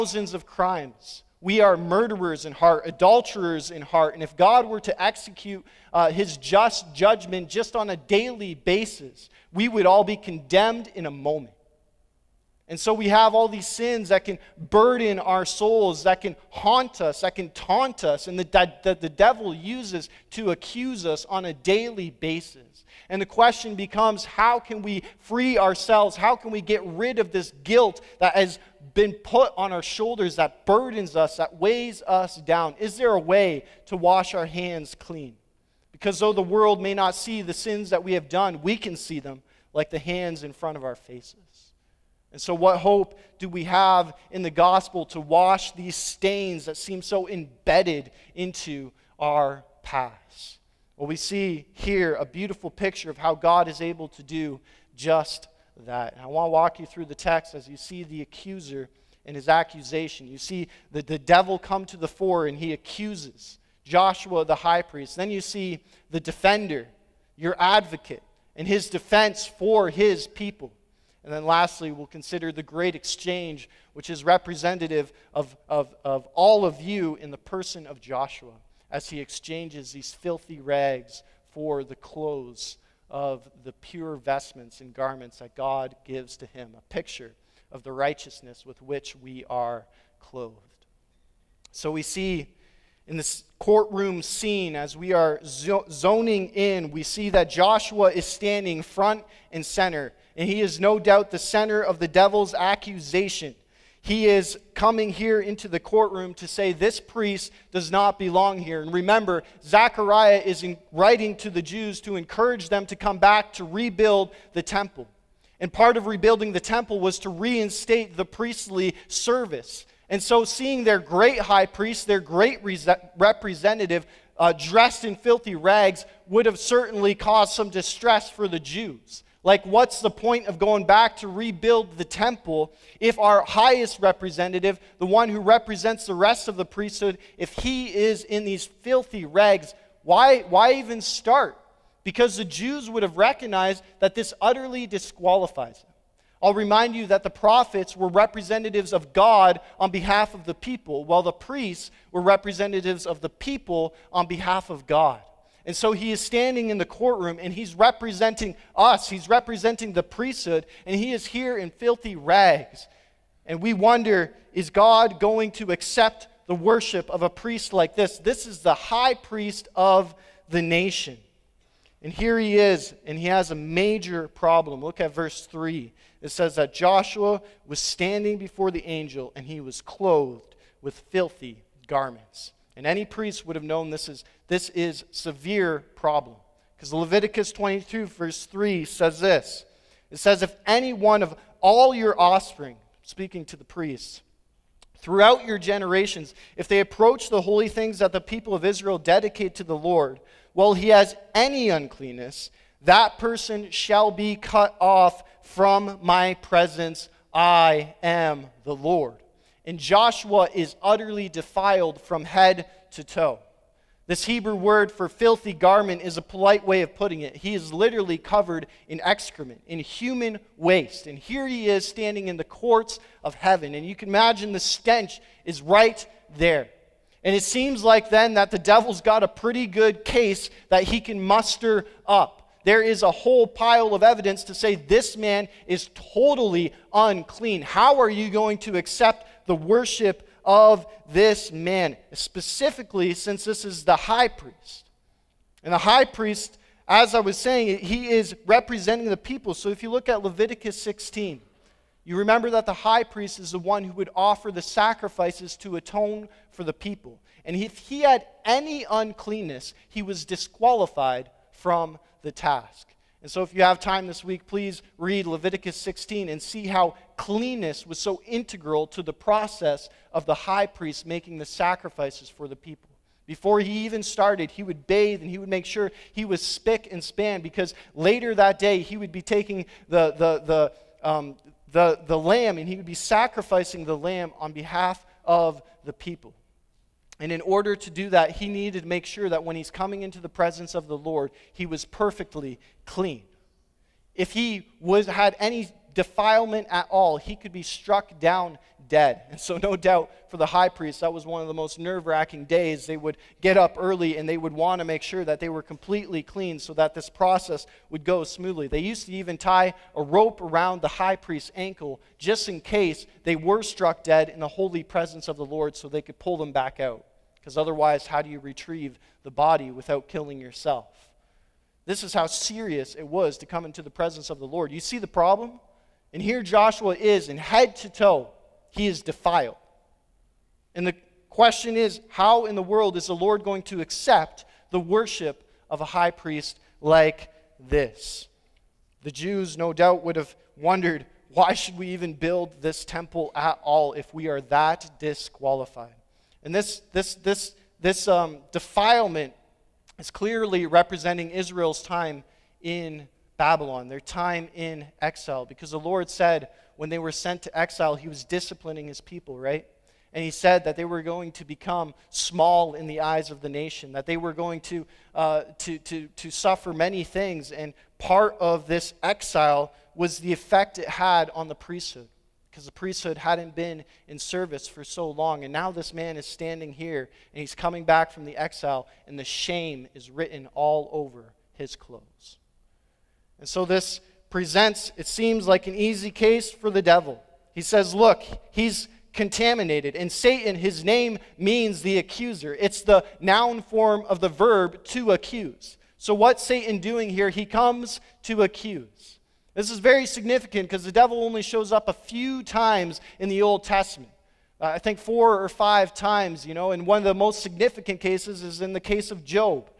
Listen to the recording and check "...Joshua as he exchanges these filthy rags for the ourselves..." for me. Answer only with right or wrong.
wrong.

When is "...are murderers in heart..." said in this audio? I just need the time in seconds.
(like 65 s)
1 s.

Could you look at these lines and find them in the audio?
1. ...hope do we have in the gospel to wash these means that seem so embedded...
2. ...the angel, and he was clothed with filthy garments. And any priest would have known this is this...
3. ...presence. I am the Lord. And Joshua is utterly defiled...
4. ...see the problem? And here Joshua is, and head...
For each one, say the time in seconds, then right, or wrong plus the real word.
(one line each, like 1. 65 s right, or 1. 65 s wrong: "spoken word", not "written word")
1. 42 s wrong: "stains", not "means"
2. 178 s right
3. 206 s right
4. 324 s right.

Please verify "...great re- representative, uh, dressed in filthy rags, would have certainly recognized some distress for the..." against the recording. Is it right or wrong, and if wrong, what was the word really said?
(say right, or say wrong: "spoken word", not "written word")
wrong: "caused", not "recognized".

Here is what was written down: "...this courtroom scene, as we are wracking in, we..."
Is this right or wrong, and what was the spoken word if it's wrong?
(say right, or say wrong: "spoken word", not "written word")
wrong: "zoning", not "wracking".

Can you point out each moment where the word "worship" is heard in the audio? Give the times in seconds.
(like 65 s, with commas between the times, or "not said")
166 s, 239 s, 334 s.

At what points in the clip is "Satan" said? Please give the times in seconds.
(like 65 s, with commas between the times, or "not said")
390 s, 396 s.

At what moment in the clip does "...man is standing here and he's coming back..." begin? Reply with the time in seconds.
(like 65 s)
375 s.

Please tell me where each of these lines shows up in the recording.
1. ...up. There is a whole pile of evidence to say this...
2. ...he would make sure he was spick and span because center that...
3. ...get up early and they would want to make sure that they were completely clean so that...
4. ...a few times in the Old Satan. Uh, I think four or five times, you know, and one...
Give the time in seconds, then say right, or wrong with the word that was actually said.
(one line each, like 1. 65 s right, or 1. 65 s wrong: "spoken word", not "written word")
1. 232 s right
2. 275 s wrong: "later", not "center"
3. 303 s right
4. 401 s wrong: "Testament", not "Satan".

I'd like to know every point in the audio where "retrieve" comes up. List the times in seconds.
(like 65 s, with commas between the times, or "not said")
318 s.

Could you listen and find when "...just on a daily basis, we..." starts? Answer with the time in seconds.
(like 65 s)
7 s.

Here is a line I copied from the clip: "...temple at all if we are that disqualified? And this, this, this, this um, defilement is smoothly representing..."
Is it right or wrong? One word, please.
wrong.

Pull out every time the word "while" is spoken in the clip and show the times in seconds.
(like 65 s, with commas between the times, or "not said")
151 s, 200 s.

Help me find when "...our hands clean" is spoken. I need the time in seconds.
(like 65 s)
34 s.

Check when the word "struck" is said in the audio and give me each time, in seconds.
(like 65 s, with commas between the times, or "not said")
297 s, 313 s.